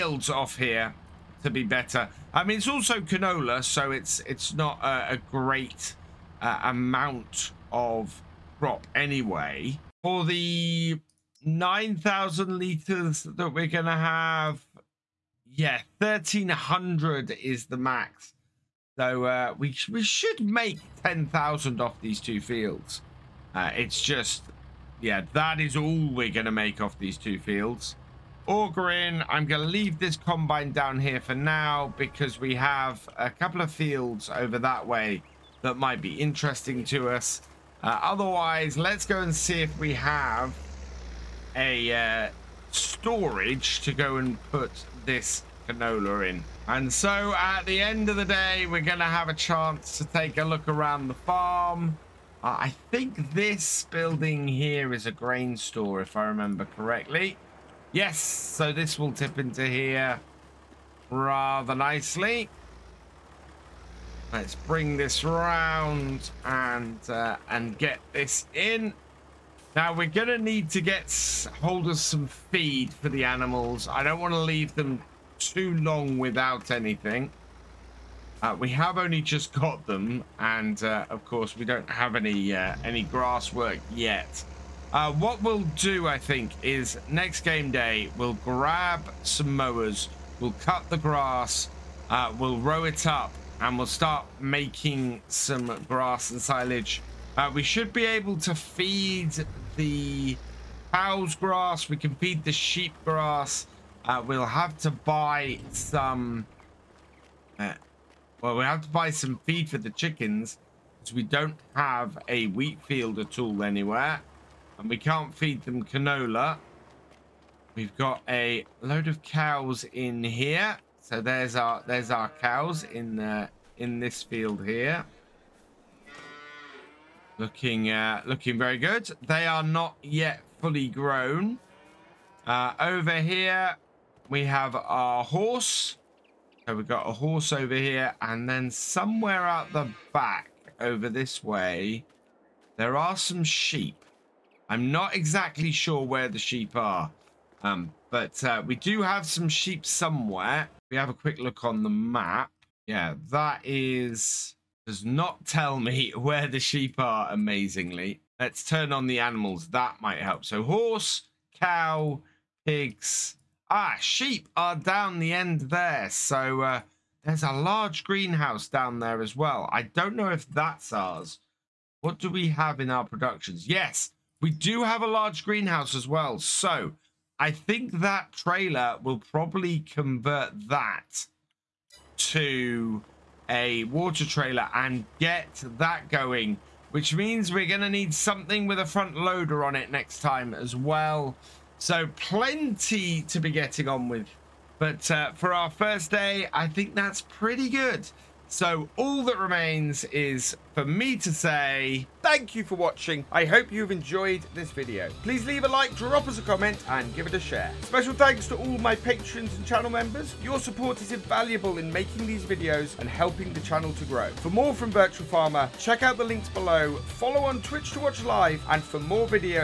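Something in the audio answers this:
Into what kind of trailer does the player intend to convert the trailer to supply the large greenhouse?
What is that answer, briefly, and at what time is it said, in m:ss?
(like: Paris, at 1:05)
water trailer, at 3:03.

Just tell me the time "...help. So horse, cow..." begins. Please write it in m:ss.
2:40.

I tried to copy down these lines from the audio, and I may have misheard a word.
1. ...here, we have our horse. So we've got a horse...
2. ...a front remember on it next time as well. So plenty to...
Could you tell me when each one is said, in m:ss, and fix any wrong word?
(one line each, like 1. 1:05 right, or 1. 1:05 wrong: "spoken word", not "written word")
1. 2:13 right
2. 3:08 wrong: "loader", not "remember".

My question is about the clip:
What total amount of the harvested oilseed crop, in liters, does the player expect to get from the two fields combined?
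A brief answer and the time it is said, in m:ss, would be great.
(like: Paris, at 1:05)
10,000, at 0:21.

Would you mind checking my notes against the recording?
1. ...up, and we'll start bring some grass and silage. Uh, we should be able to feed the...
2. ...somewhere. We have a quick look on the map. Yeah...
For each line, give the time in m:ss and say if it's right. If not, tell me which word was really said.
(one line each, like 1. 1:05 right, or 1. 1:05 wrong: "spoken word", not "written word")
1. 1:33 wrong: "making", not "bring"
2. 2:29 right.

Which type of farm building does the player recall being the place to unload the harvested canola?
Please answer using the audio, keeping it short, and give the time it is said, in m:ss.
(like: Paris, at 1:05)
grain store, at 0:55.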